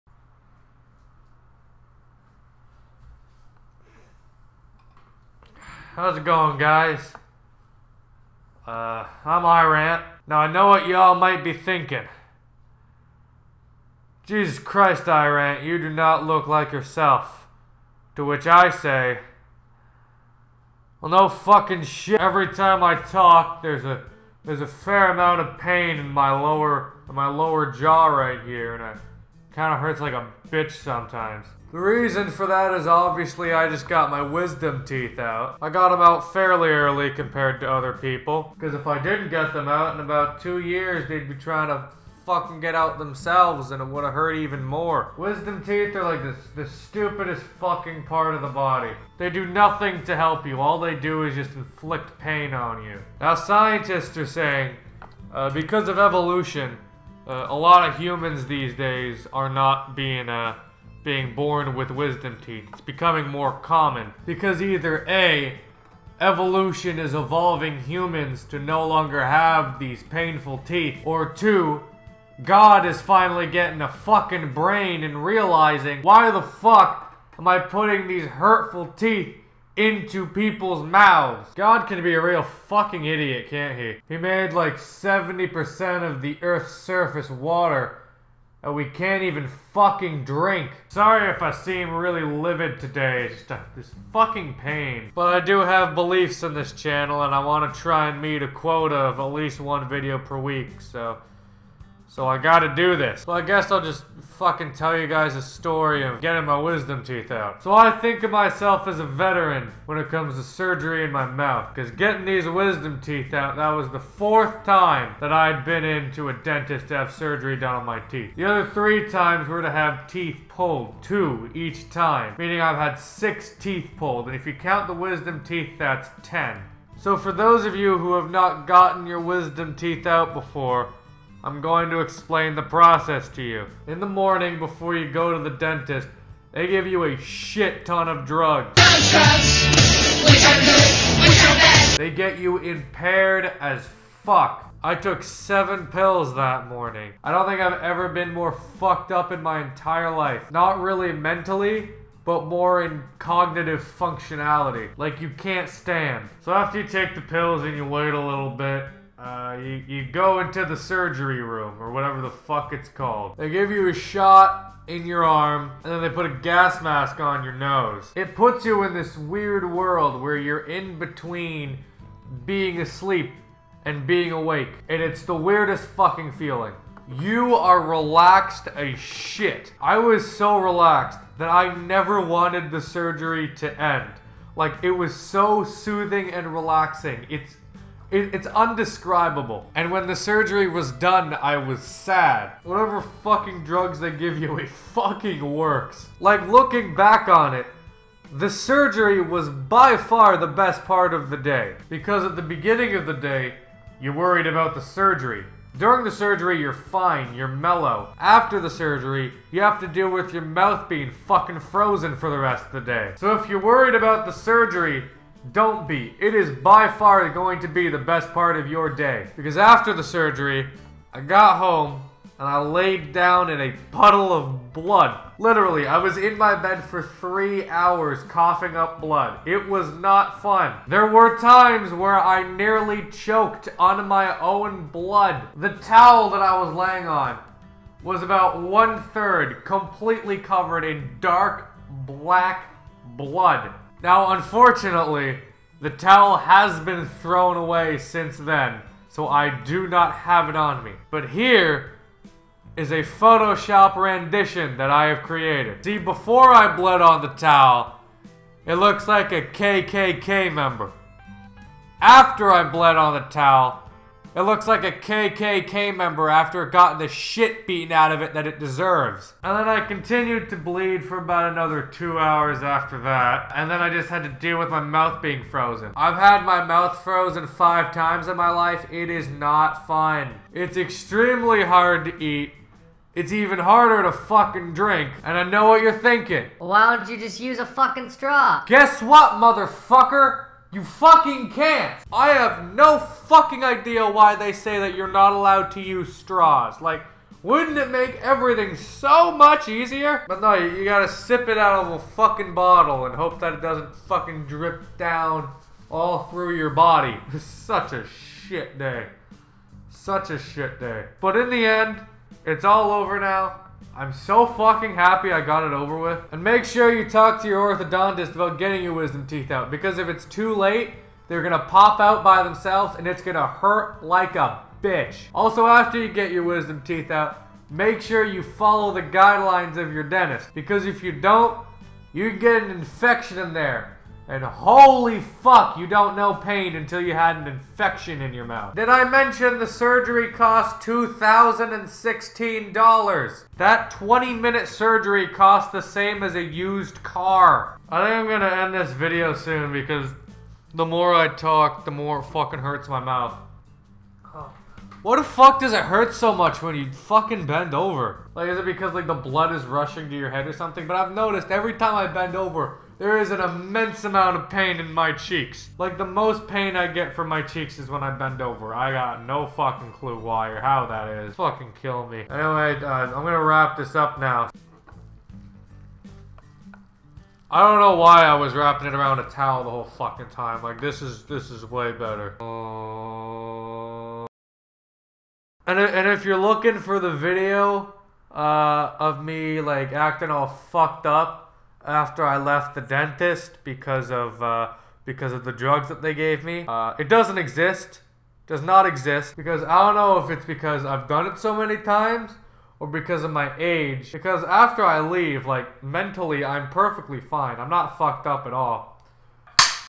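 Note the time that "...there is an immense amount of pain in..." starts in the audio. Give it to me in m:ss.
6:03.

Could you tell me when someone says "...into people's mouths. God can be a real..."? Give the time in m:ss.
1:19.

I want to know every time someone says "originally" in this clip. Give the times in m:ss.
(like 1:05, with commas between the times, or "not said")
not said.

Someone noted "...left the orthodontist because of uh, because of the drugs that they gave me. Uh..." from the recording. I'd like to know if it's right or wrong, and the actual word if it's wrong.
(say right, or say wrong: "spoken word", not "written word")
wrong: "dentist", not "orthodontist".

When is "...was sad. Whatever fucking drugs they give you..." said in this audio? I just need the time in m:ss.
3:11.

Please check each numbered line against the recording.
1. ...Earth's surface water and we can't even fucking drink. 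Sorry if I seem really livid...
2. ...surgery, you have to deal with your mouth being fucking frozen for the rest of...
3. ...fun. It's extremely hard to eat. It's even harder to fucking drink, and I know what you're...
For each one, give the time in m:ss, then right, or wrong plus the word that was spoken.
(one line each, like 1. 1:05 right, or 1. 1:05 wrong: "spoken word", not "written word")
1. 1:26 right
2. 3:28 right
3. 4:39 right.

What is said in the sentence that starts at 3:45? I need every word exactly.
Literally, I was in my bed for three hours coughing up blood.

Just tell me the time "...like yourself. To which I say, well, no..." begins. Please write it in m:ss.
0:16.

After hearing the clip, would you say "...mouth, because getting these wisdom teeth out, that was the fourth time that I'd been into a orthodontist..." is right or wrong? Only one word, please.
wrong.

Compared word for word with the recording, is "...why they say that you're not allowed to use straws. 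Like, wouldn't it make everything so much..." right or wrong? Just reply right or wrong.
right.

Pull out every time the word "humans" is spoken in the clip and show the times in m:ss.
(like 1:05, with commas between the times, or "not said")
0:57, 1:07.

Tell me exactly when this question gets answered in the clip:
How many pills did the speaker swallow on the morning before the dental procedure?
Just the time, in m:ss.
2:25.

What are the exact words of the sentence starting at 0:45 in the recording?
Wisdom teeth are like the, the stupidest fucking part of the body.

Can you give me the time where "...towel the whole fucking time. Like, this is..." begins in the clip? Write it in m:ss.
6:19.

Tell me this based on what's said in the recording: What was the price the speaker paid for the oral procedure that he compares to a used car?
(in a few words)
$2,016.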